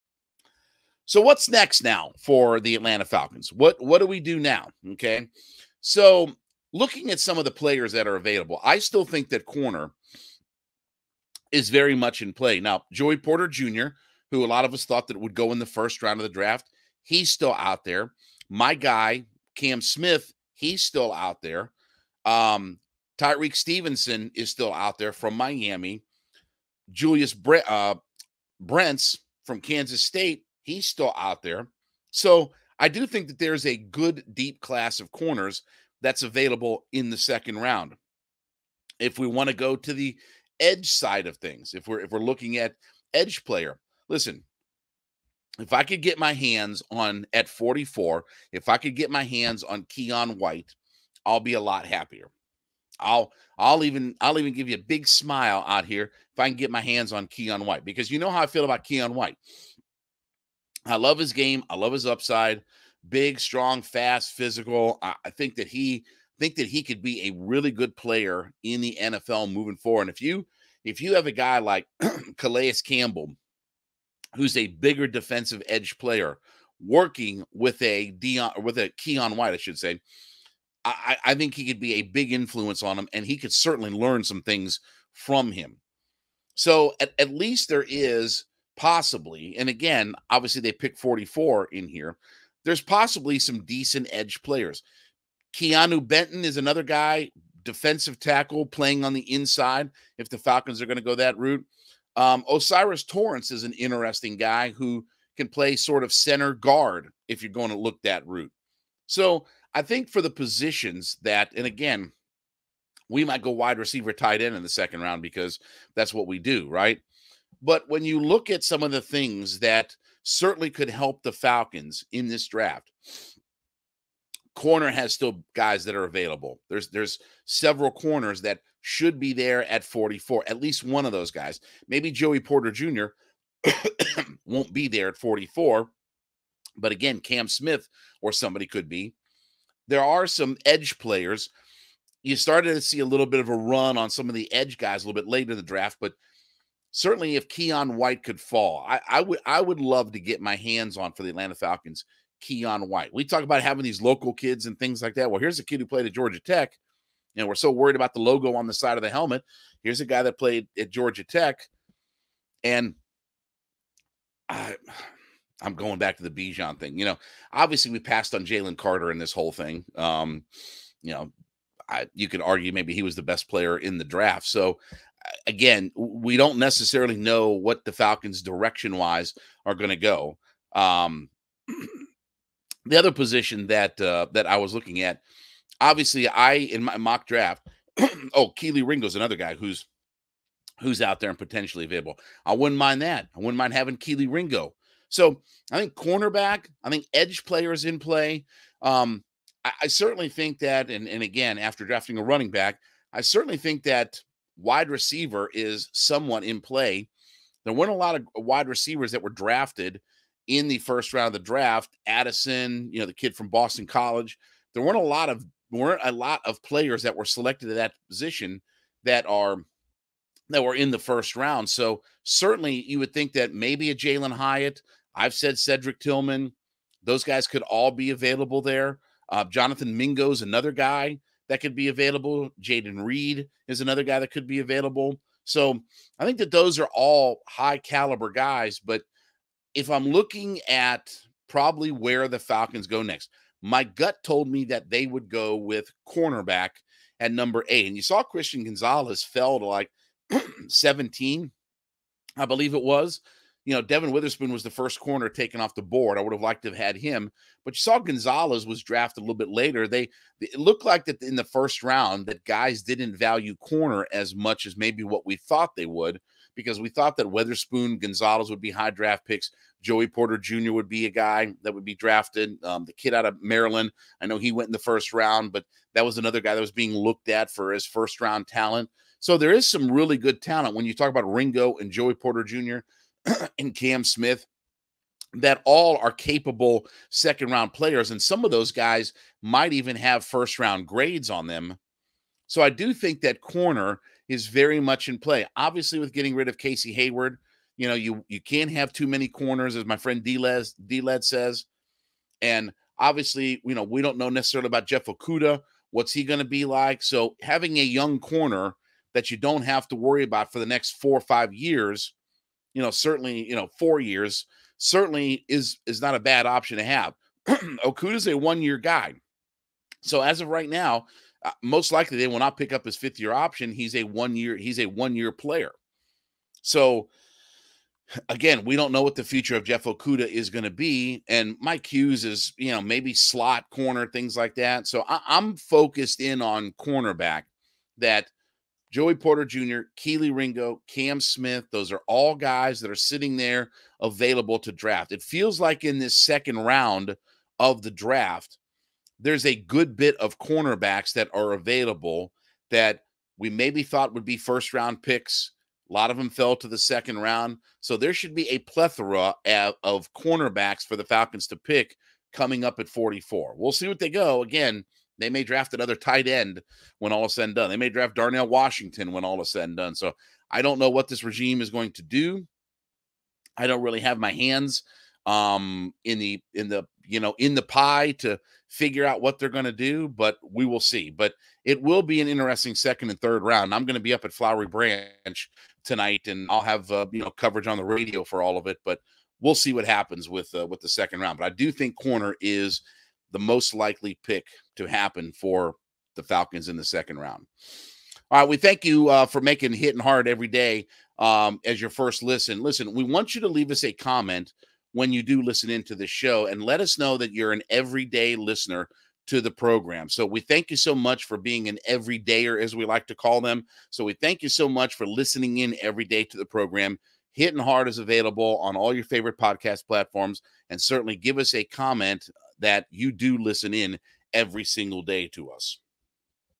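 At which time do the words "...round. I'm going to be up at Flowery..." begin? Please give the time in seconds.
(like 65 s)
383 s.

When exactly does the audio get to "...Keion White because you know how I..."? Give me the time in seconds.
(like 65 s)
57 s.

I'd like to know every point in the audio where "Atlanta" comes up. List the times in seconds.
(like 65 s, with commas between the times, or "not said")
2 s, 151 s.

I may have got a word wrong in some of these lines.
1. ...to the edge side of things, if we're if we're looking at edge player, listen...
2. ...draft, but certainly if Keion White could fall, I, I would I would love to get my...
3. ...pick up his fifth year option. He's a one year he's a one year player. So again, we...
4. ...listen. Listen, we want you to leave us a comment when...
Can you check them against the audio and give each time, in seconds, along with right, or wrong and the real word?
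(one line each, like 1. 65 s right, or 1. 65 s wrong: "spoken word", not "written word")
1. 39 s right
2. 145 s right
3. 322 s right
4. 402 s right.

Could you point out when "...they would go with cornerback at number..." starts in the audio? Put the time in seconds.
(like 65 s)
244 s.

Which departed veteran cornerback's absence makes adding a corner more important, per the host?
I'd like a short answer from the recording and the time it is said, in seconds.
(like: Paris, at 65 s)
Casey Hayward, at 296 s.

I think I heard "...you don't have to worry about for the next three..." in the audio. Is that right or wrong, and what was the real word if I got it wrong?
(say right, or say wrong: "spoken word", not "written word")
wrong: "four", not "three".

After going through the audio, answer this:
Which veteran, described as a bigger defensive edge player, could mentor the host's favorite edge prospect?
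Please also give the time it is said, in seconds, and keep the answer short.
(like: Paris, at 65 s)
Calais Campbell, at 72 s.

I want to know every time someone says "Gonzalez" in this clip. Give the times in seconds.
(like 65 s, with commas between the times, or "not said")
248 s, 257 s, 267 s.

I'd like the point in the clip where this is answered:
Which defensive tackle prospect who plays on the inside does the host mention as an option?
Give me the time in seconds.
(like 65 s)
95 s.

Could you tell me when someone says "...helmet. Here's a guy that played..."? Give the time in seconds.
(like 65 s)
159 s.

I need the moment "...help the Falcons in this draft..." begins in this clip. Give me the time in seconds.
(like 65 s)
120 s.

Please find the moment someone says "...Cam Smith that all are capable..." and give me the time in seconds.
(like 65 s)
283 s.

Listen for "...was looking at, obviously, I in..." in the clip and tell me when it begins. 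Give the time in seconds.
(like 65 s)
184 s.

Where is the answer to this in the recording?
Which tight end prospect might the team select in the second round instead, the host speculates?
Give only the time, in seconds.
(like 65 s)
368 s.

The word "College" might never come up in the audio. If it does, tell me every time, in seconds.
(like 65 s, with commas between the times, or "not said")
213 s.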